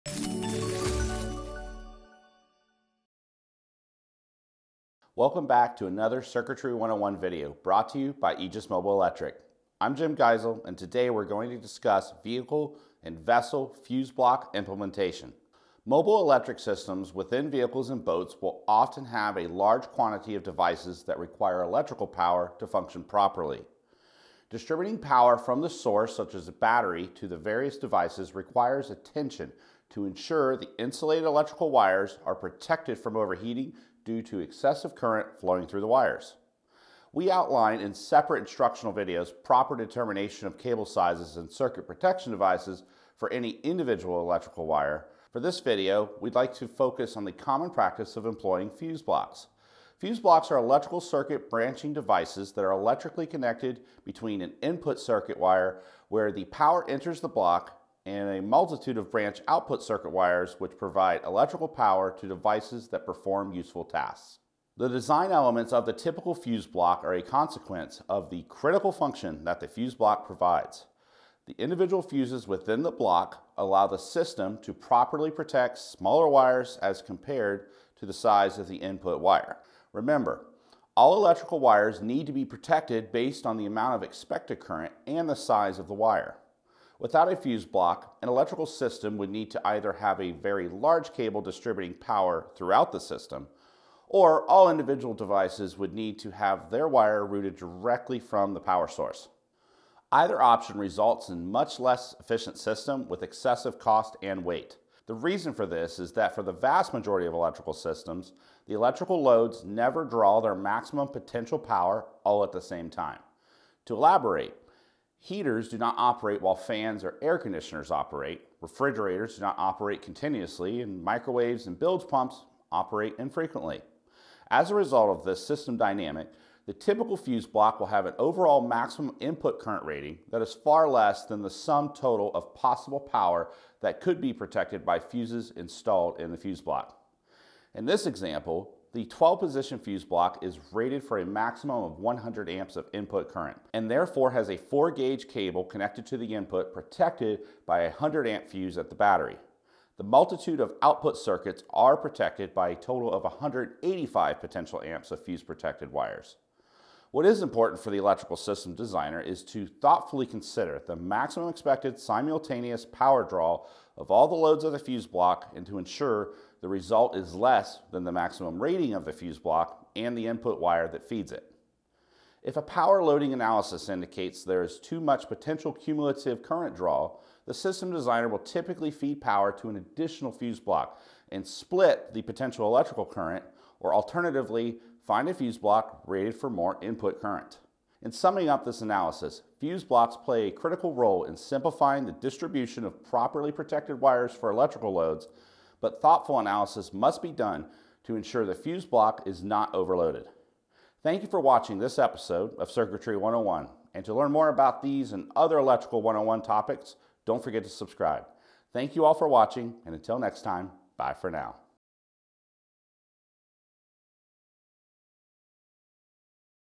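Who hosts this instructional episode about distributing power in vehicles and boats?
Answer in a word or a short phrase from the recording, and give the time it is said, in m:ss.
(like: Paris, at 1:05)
Jim Geisel, at 0:09.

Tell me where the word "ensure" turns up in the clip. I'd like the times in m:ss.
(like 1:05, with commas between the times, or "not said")
0:30, 2:45, 3:18.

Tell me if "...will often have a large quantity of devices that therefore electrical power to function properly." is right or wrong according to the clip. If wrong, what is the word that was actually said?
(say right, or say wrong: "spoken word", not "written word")
wrong: "require", not "therefore".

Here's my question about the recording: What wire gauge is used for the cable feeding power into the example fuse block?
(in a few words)
4 gauge.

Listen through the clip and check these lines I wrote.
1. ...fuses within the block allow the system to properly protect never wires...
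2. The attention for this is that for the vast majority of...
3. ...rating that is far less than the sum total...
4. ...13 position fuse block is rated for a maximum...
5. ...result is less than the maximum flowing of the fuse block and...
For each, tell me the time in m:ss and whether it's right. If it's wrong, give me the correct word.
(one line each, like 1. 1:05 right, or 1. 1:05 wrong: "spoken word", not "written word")
1. 1:12 wrong: "smaller", not "never"
2. 1:45 wrong: "reason", not "attention"
3. 2:09 right
4. 2:19 wrong: "12", not "13"
5. 2:46 wrong: "rating", not "flowing".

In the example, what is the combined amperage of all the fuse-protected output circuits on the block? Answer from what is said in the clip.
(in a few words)
185 amps.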